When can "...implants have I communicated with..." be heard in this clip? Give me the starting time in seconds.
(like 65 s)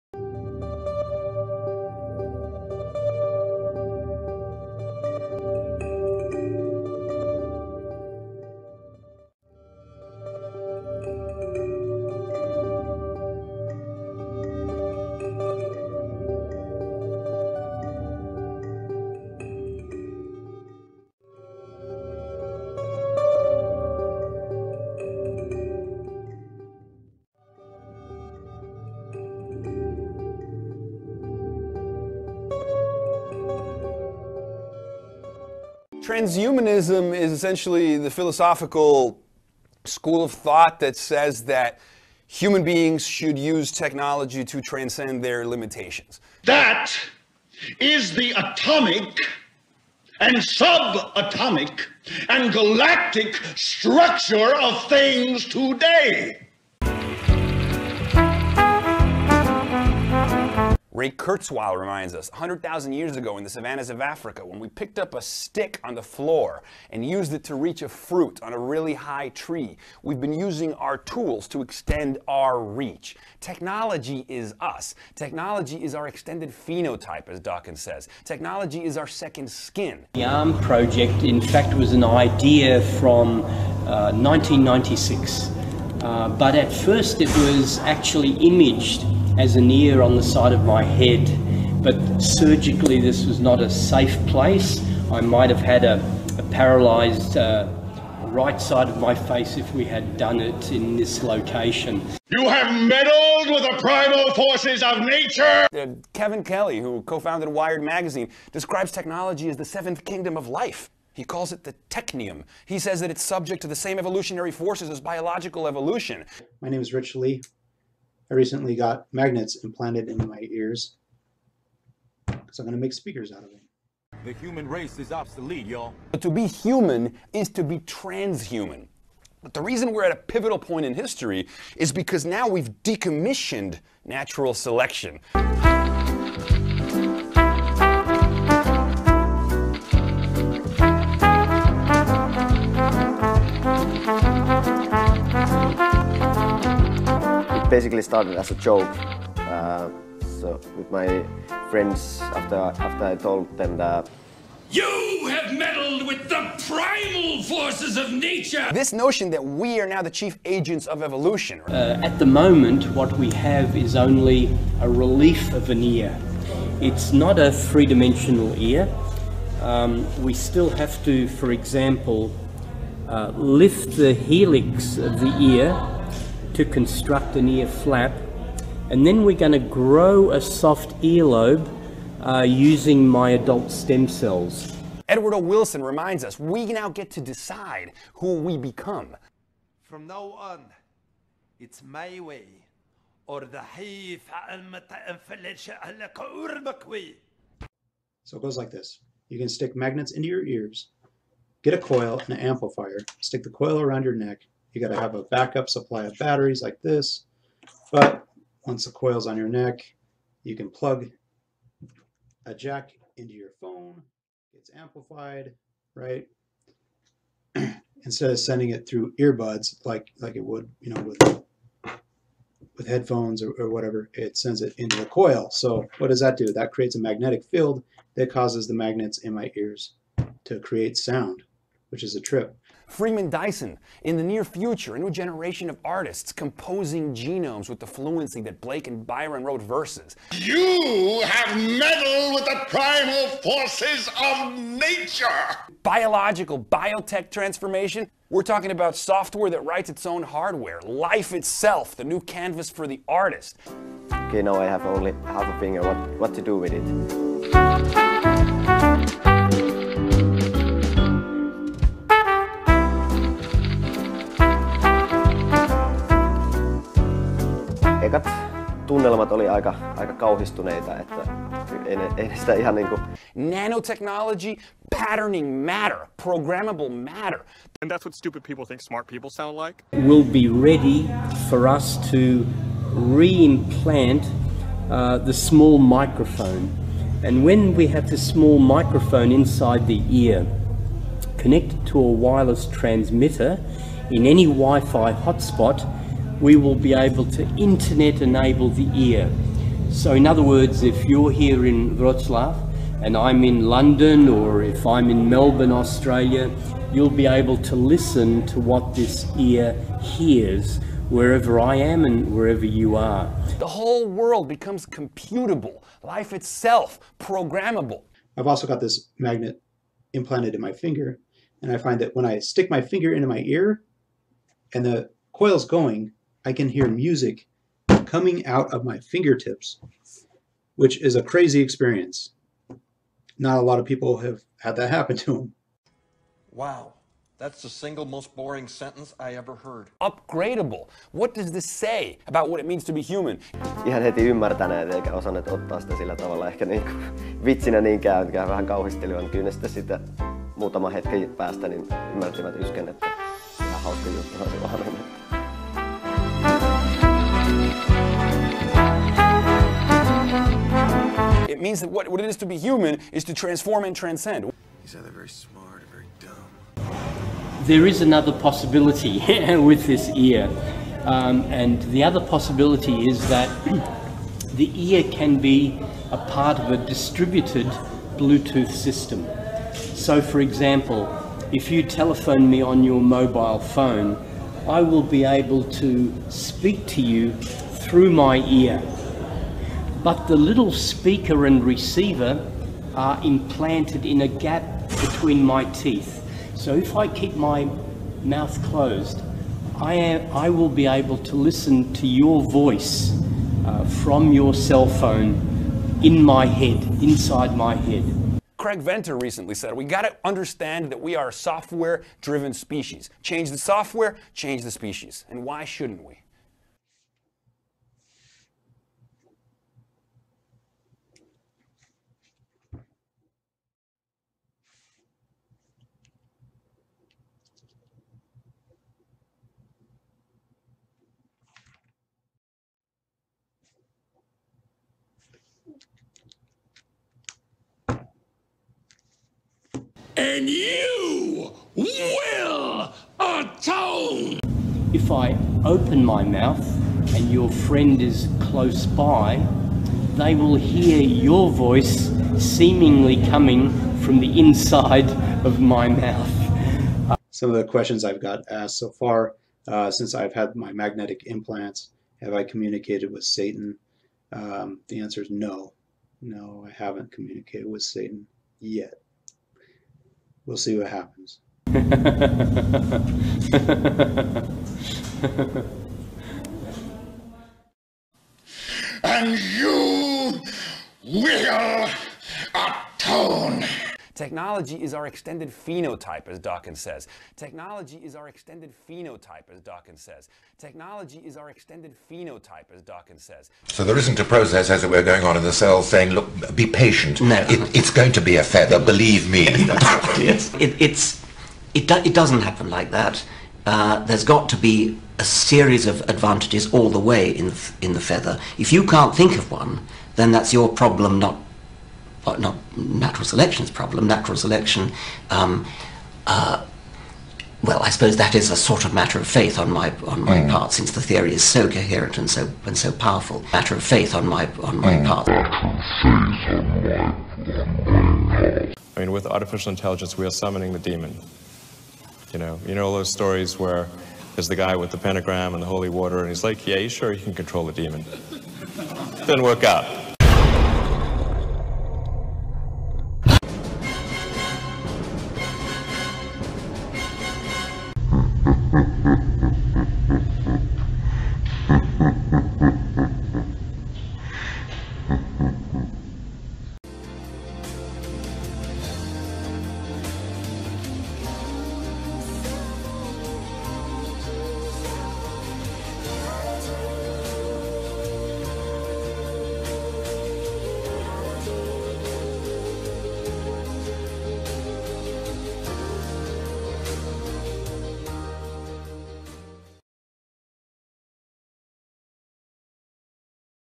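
461 s.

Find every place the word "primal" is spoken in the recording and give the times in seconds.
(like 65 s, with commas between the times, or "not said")
103 s, 156 s, 242 s.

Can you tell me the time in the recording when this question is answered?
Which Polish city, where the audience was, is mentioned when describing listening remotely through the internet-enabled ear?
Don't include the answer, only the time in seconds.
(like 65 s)
301 s.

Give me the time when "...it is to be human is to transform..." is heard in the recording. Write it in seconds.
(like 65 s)
362 s.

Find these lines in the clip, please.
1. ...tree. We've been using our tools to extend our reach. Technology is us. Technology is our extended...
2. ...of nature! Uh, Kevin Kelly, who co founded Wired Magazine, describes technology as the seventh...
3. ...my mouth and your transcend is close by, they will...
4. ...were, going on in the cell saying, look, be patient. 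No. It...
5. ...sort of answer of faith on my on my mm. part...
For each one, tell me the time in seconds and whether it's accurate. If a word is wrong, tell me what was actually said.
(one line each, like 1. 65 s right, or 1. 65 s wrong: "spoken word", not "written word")
1. 69 s right
2. 104 s right
3. 446 s wrong: "friend", not "transcend"
4. 494 s right
5. 518 s wrong: "matter", not "answer".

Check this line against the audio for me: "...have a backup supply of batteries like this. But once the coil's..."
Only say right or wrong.
right.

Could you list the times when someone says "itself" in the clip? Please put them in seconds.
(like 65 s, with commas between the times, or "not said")
251 s, 316 s.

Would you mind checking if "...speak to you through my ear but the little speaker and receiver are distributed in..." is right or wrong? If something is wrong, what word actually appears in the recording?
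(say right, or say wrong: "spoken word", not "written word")
wrong: "implanted", not "distributed".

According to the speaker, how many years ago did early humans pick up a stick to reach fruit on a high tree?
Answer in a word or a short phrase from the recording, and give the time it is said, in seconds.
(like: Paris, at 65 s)
100,000, at 62 s.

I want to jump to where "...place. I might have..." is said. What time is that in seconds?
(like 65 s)
94 s.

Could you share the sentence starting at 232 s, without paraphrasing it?
Freeman Dyson, in the near future, a new generation of artists composing genomes with the fluency that Blake and Byron wrote verses.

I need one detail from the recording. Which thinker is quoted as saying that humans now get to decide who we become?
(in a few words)
Edward O. Wilson.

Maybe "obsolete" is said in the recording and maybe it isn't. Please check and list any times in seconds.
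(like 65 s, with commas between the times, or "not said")
125 s.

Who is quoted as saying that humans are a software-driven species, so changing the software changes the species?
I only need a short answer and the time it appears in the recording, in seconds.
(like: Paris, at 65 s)
Craig Venter, at 408 s.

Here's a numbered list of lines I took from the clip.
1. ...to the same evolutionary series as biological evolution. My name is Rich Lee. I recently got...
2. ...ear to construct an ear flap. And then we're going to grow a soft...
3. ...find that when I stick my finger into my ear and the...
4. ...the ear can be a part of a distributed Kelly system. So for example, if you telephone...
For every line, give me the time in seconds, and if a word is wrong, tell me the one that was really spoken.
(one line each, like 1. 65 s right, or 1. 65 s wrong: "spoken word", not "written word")
1. 113 s wrong: "forces", not "series"
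2. 175 s right
3. 321 s right
4. 374 s wrong: "Bluetooth", not "Kelly".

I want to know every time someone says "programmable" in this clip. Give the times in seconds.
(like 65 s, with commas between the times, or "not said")
276 s, 317 s.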